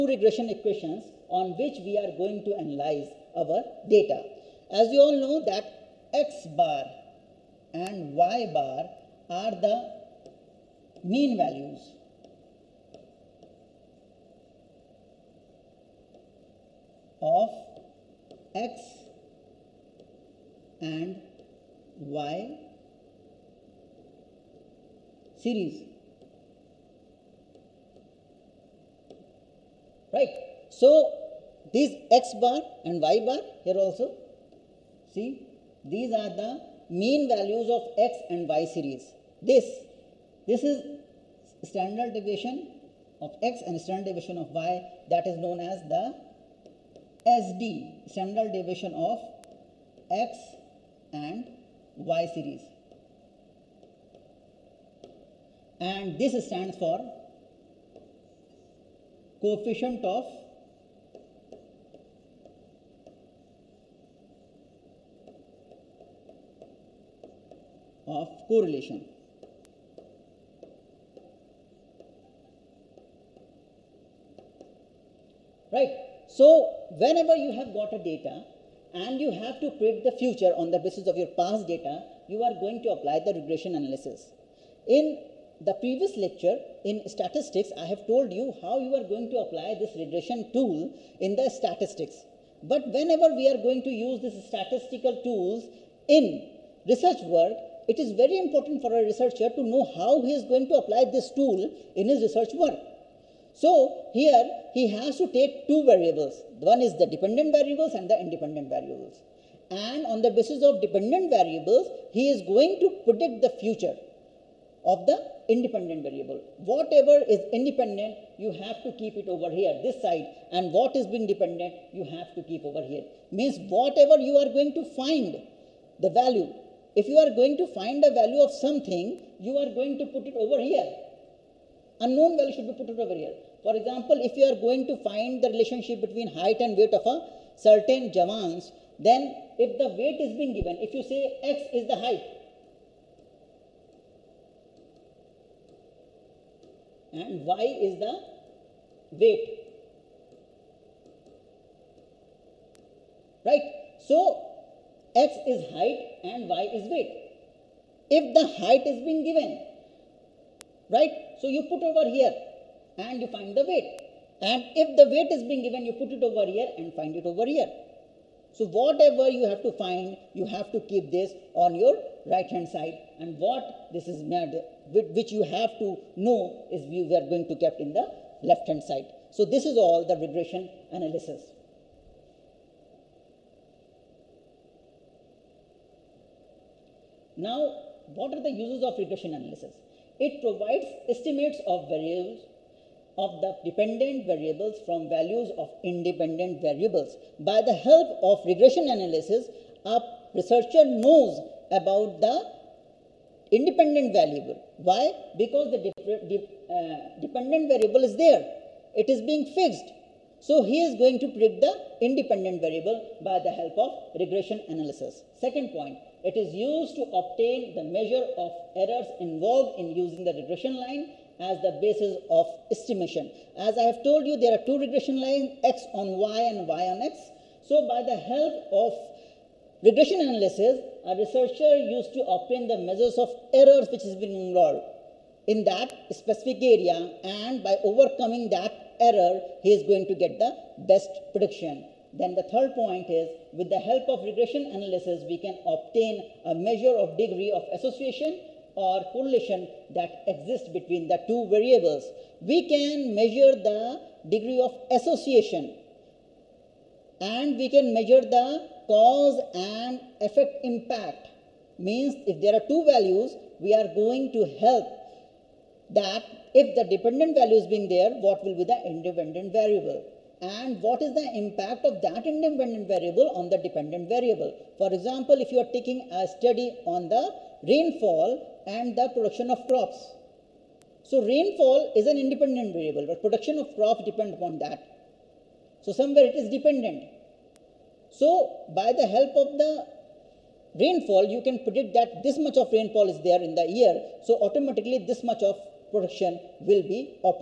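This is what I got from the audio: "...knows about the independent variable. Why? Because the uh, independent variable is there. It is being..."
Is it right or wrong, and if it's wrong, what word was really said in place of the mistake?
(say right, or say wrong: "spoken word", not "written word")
wrong: "dependent", not "independent".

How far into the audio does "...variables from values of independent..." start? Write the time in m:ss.
3:14.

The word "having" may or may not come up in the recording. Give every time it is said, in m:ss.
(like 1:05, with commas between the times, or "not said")
not said.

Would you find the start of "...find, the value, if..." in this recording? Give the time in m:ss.
2:04.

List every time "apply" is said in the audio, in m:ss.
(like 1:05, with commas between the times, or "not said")
1:22, 1:29, 1:40.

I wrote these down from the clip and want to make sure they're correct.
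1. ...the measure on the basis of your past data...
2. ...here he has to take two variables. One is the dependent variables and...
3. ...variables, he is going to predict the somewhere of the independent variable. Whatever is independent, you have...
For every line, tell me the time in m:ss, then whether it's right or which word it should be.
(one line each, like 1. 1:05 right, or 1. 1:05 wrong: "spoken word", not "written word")
1. 1:20 wrong: "future", not "measure"
2. 1:44 right
3. 1:51 wrong: "future", not "somewhere".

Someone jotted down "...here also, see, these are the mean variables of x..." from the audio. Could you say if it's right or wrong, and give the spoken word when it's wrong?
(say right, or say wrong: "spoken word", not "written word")
wrong: "values", not "variables".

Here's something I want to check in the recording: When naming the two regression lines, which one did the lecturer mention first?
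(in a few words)
x on y.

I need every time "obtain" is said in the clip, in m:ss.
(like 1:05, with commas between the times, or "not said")
3:37, 3:52, 4:05.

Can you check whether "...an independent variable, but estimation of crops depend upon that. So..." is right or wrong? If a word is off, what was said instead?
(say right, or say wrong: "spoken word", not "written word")
wrong: "production", not "estimation".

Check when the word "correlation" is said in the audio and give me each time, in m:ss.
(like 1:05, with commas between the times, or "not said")
1:08, 4:09.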